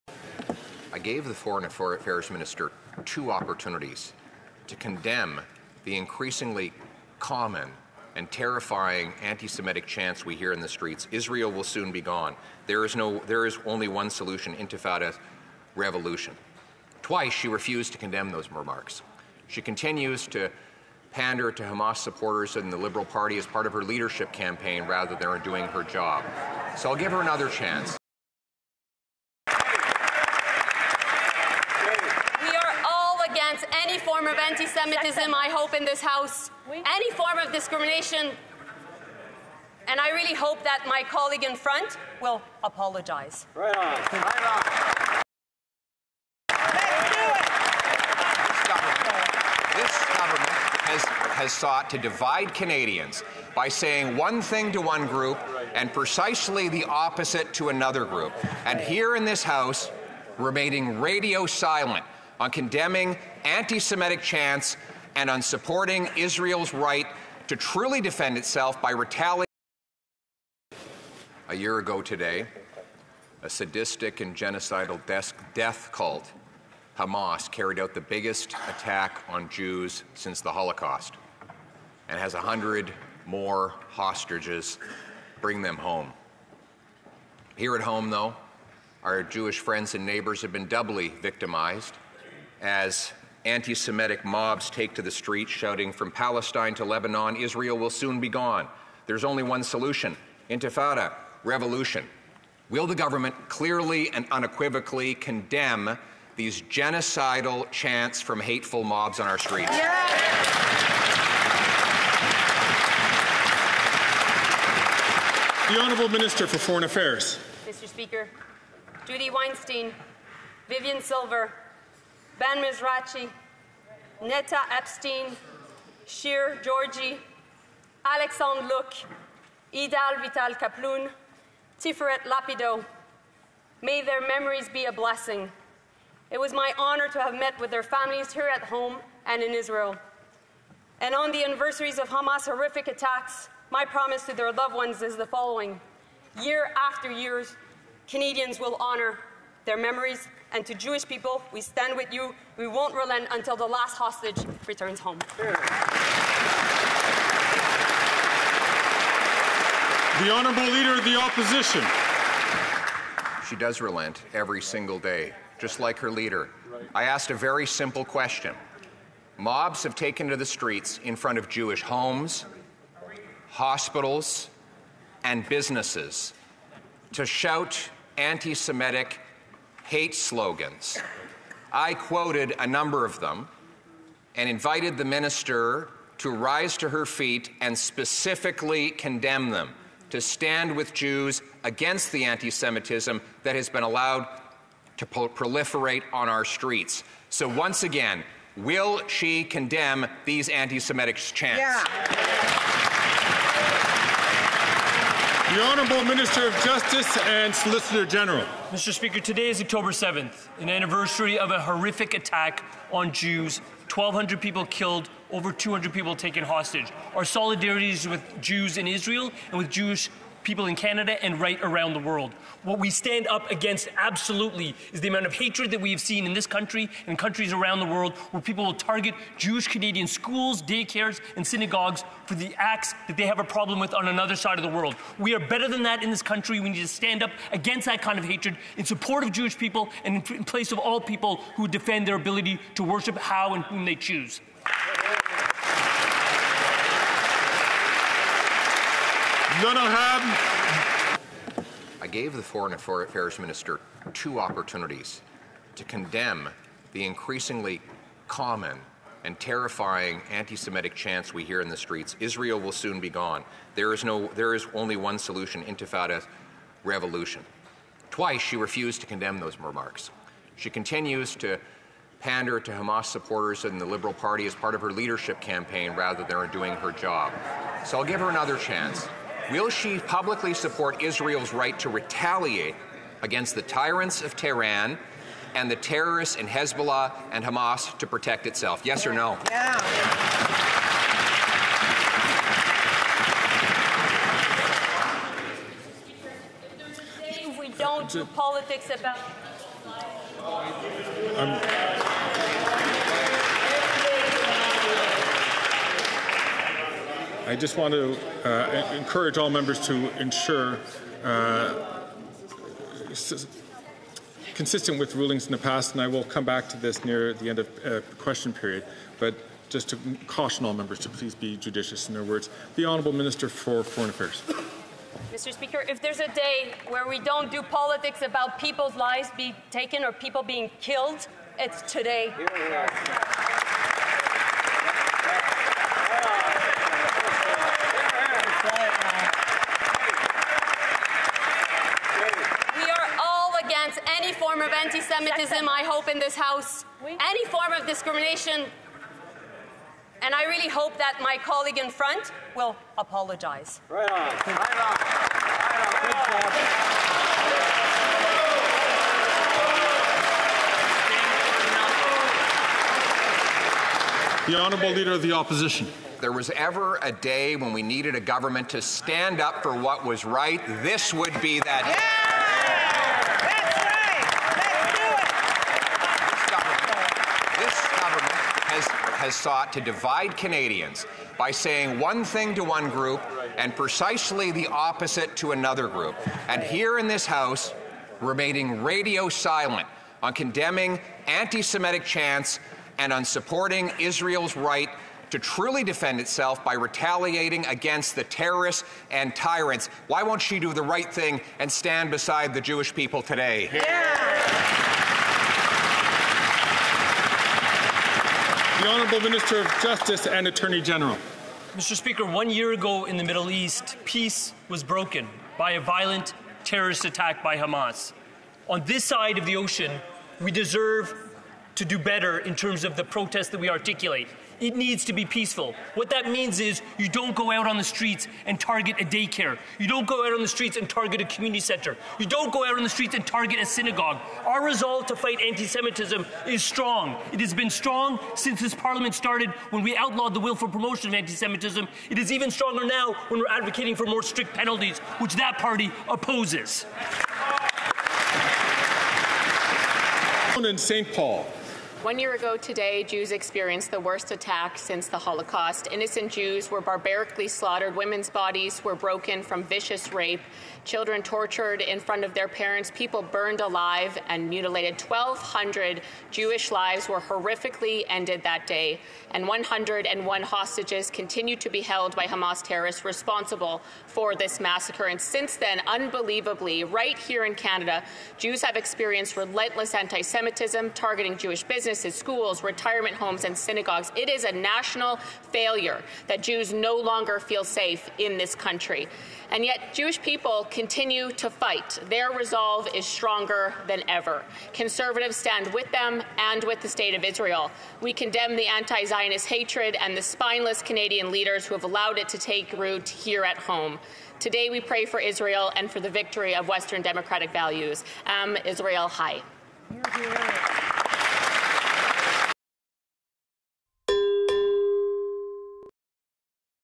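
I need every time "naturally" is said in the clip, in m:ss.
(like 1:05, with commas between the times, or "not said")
not said.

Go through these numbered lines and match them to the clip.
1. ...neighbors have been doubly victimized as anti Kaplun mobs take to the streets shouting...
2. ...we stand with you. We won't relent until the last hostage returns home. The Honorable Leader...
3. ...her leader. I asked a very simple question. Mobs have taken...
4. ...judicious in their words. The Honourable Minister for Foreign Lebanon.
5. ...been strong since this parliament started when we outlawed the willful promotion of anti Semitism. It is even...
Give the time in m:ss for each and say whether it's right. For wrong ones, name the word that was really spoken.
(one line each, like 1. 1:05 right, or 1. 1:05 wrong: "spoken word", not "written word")
1. 1:30 wrong: "Semitic", not "Kaplun"
2. 2:31 right
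3. 2:45 right
4. 5:21 wrong: "Affairs", not "Lebanon"
5. 7:17 right.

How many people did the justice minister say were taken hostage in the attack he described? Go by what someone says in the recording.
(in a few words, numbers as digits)
over 200.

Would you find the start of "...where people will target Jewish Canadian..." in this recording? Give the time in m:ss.
3:48.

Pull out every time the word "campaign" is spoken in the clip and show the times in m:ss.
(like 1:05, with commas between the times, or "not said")
0:24, 4:35.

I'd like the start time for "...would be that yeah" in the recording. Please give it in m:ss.
6:11.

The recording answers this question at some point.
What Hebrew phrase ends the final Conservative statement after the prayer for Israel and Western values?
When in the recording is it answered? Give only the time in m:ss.
8:28.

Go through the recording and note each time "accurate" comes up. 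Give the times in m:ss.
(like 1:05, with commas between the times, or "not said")
not said.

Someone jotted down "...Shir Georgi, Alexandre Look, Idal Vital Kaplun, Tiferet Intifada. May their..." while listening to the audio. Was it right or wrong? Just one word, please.
wrong.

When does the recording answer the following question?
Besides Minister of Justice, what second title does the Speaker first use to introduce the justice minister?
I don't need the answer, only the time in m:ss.
3:27.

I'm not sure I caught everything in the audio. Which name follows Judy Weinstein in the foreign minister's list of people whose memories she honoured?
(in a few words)
Vivian Silver.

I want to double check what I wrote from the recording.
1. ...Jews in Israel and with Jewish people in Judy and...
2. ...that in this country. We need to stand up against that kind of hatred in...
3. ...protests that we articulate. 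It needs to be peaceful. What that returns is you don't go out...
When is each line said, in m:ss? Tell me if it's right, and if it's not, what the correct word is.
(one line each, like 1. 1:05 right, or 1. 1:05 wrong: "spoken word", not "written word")
1. 3:38 wrong: "Canada", not "Judy"
2. 3:55 right
3. 7:03 wrong: "means", not "returns".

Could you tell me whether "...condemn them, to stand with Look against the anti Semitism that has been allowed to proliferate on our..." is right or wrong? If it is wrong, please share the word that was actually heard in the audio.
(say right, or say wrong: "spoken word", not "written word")
wrong: "Jews", not "Look".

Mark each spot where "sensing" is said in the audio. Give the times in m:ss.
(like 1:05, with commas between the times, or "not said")
not said.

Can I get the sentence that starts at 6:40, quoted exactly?
Why won't she do the right thing and stand beside the Jewish people today?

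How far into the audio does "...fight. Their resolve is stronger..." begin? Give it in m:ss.
8:11.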